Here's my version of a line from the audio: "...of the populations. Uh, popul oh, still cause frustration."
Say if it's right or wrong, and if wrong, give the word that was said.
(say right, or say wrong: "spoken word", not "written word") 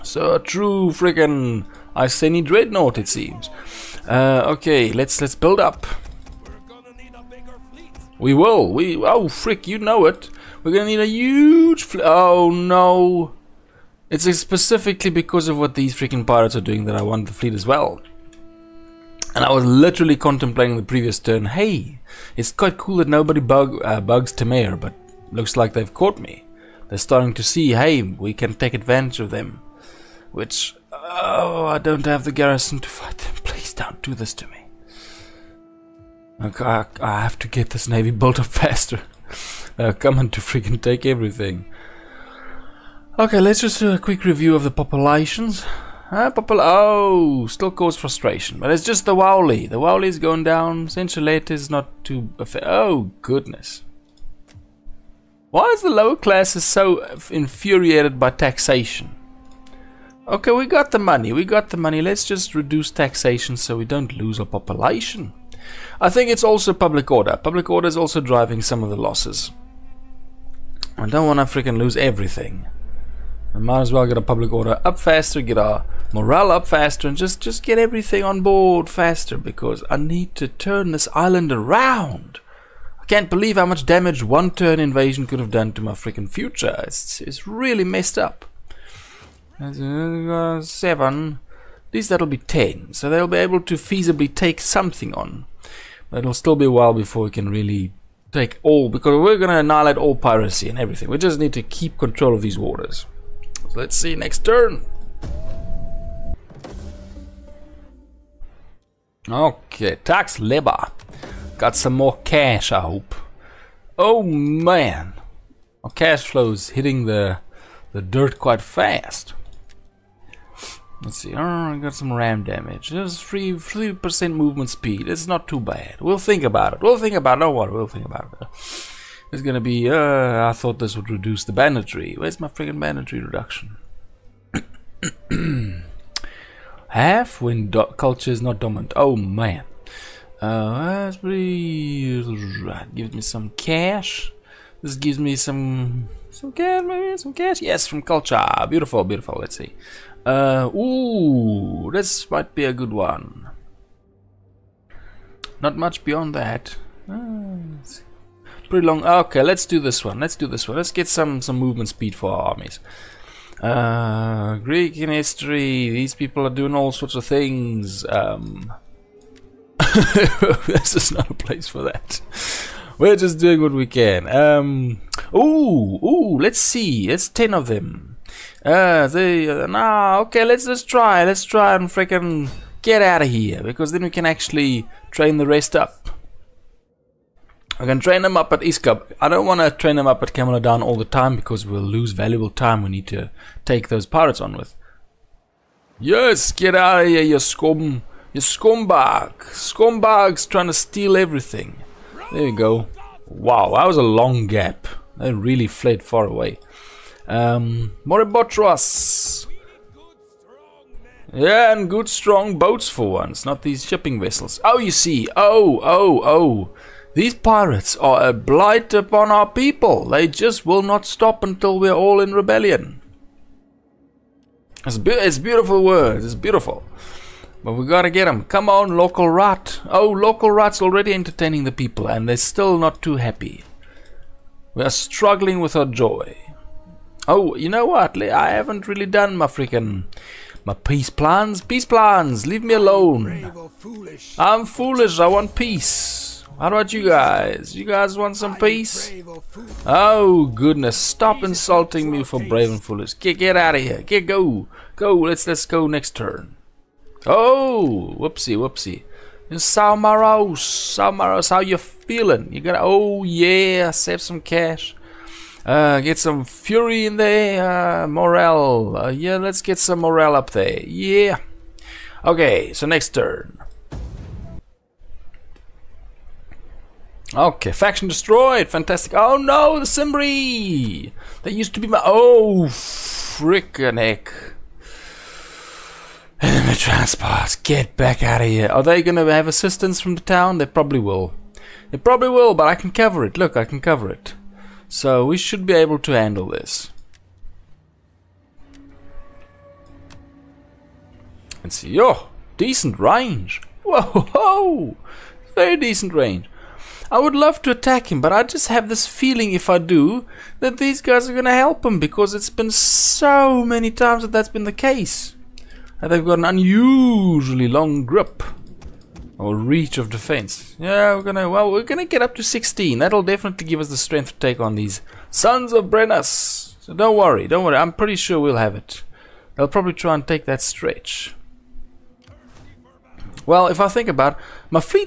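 right.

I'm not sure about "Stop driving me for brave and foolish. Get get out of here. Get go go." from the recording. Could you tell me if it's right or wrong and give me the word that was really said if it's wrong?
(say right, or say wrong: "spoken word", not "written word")
wrong: "insulting", not "driving".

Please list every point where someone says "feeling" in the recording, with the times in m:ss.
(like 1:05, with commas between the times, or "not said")
4:21, 5:09.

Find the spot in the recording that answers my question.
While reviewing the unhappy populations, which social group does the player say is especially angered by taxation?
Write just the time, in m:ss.
0:55.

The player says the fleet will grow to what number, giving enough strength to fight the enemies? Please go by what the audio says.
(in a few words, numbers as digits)
16.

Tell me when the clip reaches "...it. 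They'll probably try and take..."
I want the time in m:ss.
5:28.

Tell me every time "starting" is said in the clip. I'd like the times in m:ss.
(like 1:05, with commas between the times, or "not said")
0:26.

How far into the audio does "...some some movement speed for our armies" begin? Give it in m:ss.
2:41.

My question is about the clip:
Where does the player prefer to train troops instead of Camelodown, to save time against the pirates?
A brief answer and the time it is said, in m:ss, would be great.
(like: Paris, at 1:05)
East Cup, at 3:08.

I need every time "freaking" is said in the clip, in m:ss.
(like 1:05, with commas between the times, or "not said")
0:00, 0:15, 0:40, 1:11, 1:25, 3:01, 3:59.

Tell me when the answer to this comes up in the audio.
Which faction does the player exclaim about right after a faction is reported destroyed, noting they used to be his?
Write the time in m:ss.
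4:39.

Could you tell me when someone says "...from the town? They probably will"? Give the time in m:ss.
4:50.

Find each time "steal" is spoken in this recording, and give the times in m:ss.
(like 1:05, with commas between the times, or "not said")
3:20.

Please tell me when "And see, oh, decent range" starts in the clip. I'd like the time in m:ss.
5:01.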